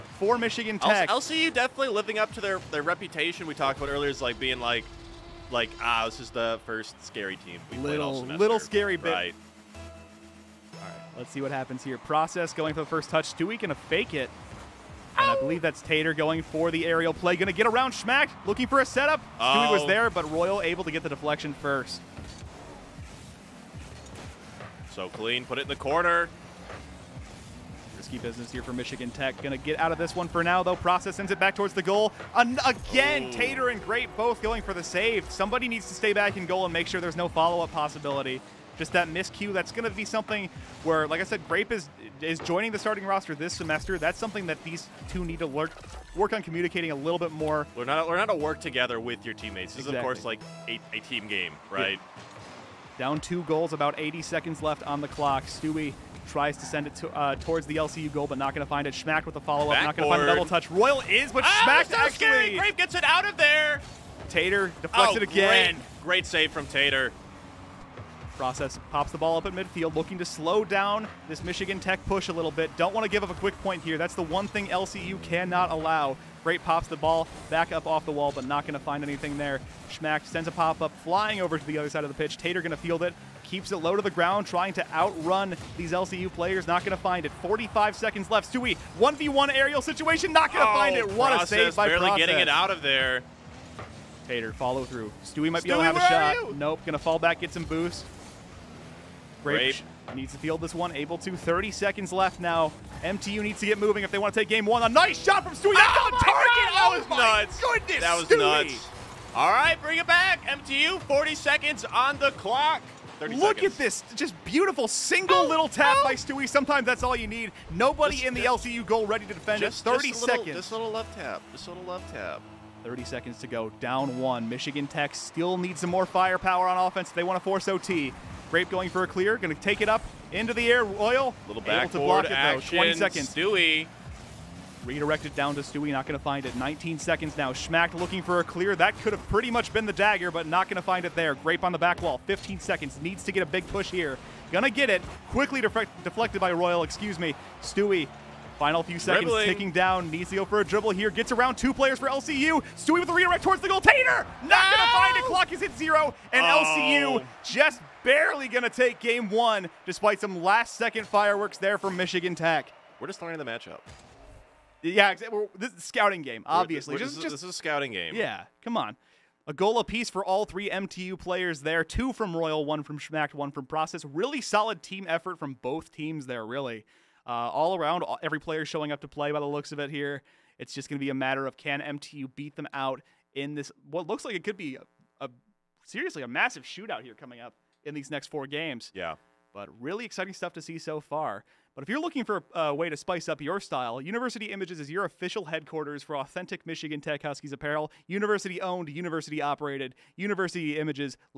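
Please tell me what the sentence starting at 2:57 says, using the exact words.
Uh, all around, every player showing up to play by the looks of it here.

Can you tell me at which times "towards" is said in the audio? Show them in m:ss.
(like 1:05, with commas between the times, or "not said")
0:31, 0:57, 2:33.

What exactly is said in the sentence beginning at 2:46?
We're, we're, just, this, just, this is a scouting game.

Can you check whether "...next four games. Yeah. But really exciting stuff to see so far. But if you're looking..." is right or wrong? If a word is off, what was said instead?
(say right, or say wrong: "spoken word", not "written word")
right.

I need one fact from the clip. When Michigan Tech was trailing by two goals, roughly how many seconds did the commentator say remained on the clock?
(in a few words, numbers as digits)
80 seconds.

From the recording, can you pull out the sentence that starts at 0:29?
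Gonna get out of this one for now, though.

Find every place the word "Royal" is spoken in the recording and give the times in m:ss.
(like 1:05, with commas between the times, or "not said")
0:20, 1:00, 2:10, 2:26, 2:52.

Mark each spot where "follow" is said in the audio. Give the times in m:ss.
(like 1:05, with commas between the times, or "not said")
0:37, 0:59, 1:34.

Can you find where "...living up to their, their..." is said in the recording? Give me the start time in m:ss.
0:01.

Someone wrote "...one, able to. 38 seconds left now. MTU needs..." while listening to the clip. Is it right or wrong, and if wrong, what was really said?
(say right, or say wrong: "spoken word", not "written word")
wrong: "30", not "38".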